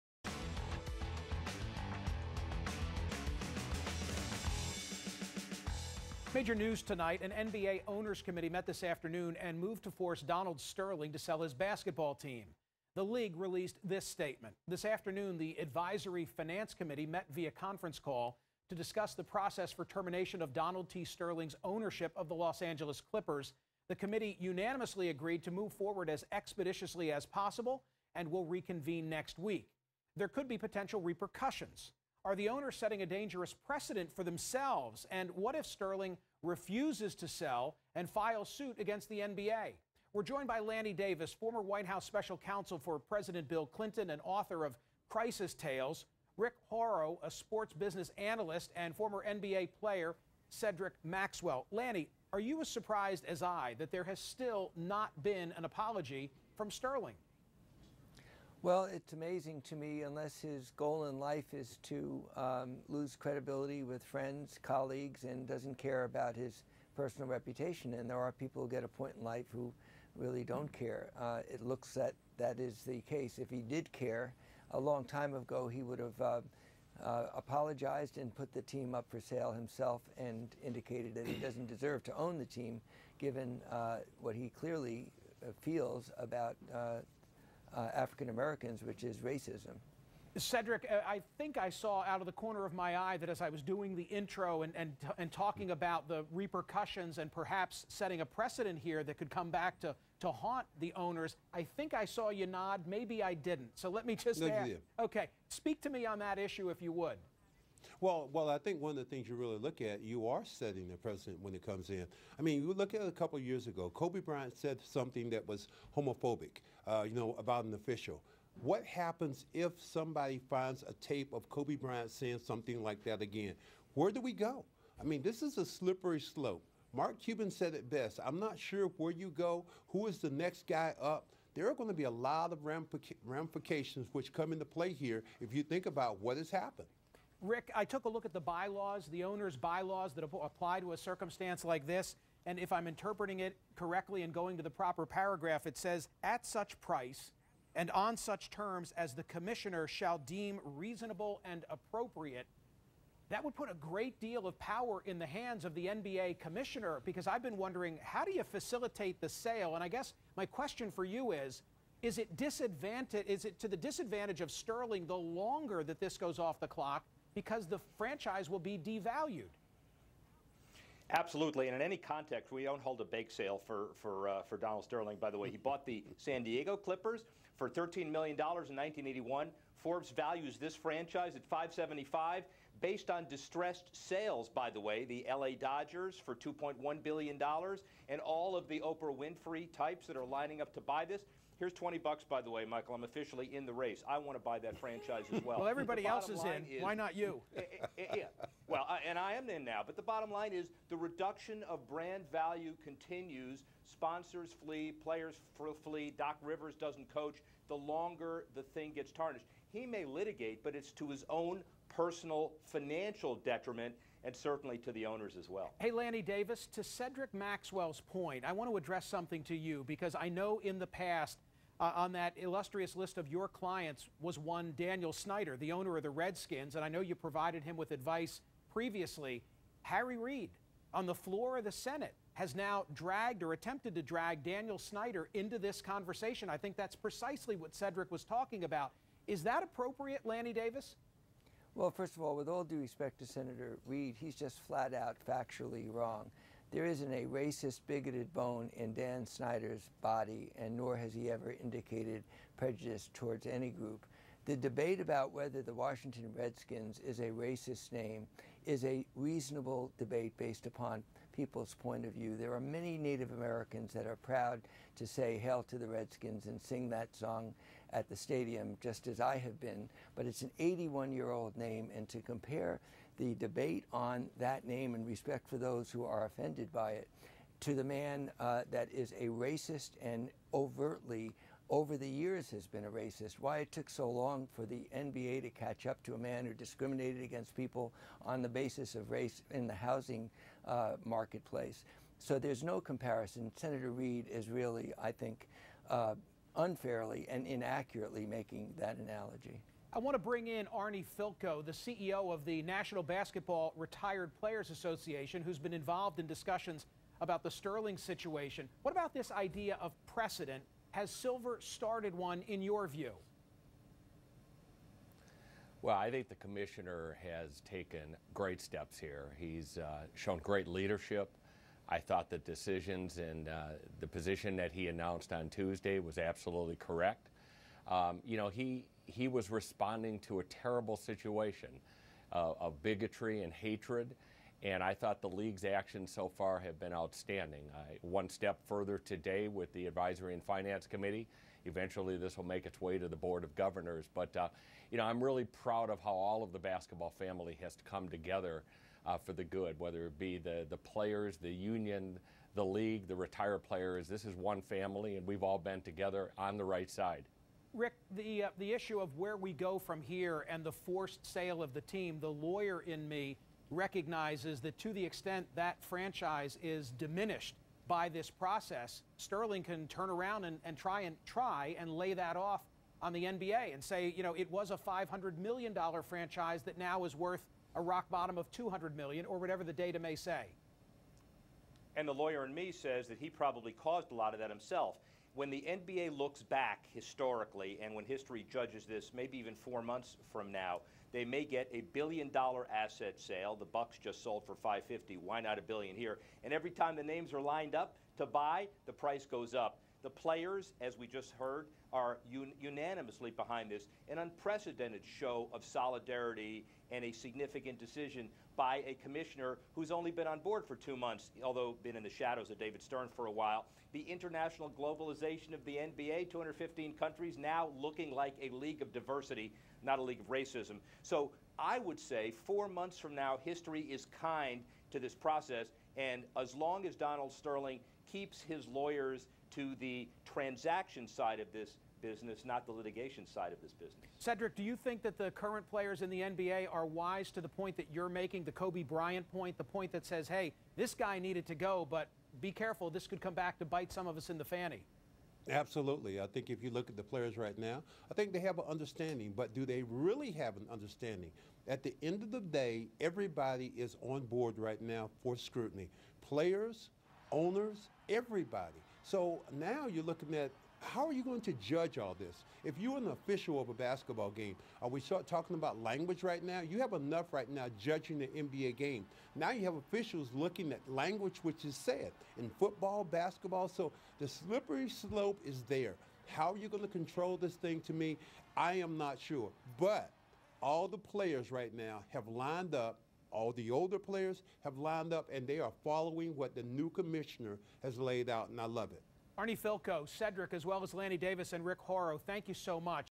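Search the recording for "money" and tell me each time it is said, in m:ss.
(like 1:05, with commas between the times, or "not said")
not said.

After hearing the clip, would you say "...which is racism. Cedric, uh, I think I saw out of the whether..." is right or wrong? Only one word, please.
wrong.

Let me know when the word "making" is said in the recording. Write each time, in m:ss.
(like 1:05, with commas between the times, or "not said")
4:58, 7:18.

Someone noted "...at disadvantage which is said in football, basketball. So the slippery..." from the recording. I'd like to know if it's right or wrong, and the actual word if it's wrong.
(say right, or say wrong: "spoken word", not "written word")
wrong: "language", not "disadvantage".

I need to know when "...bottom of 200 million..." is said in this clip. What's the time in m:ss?
6:18.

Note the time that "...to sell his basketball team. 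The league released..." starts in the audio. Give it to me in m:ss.
0:11.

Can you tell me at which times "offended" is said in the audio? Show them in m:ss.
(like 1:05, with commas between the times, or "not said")
4:36.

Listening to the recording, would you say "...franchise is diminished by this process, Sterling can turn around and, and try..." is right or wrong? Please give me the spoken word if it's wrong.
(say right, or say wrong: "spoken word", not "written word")
right.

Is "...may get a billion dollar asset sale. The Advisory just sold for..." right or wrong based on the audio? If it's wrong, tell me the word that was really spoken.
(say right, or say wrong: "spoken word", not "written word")
wrong: "Bucks", not "Advisory".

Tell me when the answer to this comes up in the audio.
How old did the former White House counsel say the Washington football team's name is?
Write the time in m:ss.
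4:30.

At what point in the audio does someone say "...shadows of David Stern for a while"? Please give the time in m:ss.
6:52.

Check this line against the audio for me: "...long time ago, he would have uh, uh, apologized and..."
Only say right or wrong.
right.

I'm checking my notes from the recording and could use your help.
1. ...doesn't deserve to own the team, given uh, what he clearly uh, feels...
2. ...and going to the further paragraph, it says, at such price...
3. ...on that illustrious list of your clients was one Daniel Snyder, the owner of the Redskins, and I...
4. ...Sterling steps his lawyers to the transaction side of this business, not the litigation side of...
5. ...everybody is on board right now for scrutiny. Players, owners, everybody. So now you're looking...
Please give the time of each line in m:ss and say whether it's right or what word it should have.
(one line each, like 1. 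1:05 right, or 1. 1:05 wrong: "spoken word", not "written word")
1. 1:21 right
2. 2:24 wrong: "proper", not "further"
3. 3:41 right
4. 7:07 wrong: "keeps", not "steps"
5. 7:32 right.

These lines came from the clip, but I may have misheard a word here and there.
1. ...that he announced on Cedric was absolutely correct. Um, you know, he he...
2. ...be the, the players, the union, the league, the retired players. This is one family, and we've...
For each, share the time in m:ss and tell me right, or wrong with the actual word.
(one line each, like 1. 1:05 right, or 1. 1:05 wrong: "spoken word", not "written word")
1. 5:24 wrong: "Tuesday", not "Cedric"
2. 5:50 right.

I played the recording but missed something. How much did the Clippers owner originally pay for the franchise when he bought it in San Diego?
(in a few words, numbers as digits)
$13 million.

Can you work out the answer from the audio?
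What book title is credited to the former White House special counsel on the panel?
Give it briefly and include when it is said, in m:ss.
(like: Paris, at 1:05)
Crisis Tales, at 0:45.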